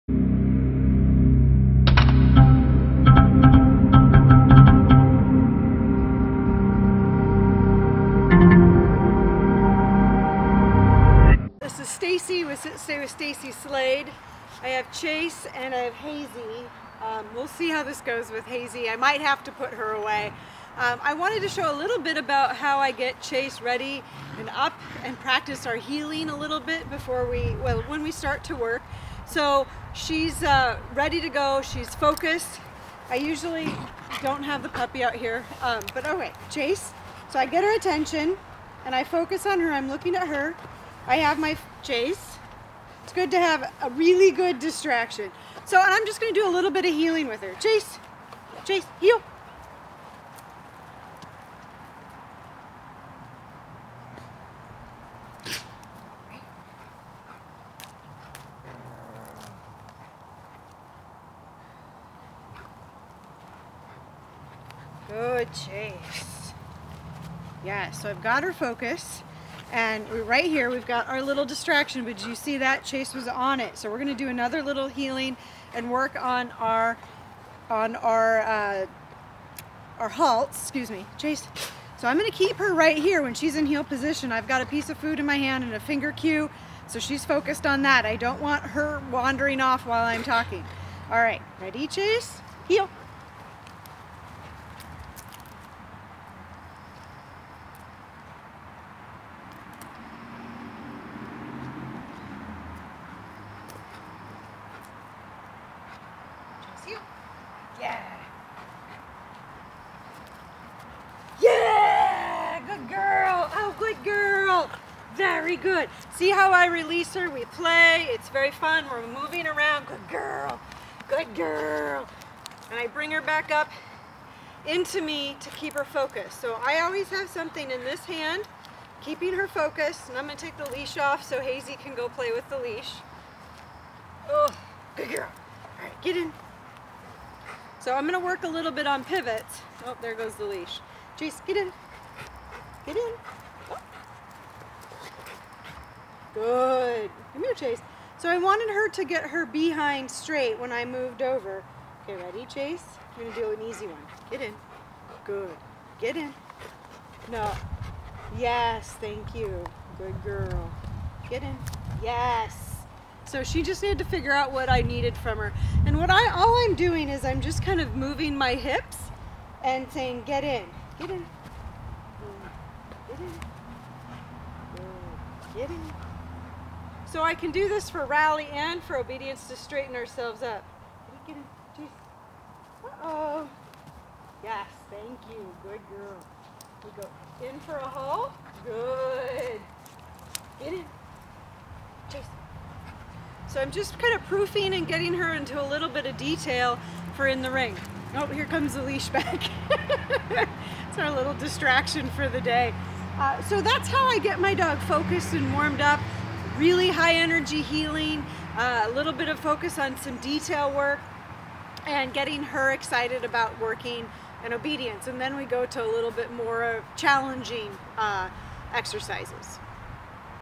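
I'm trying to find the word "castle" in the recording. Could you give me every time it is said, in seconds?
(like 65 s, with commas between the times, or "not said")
not said.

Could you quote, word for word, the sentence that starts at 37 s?
So I get her attention and I focus on her.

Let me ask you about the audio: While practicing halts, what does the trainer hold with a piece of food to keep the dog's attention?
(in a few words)
finger cue.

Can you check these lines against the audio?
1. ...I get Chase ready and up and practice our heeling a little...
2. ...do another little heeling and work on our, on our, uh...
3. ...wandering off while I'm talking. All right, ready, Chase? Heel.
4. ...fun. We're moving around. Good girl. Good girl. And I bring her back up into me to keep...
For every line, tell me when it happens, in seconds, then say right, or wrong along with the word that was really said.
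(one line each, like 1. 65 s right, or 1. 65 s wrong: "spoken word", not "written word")
1. 22 s right
2. 74 s right
3. 89 s right
4. 118 s right.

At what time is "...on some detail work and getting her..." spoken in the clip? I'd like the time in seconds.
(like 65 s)
209 s.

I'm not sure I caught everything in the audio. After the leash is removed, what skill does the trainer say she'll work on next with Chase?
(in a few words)
pivots.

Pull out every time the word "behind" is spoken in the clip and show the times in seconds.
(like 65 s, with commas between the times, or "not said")
149 s.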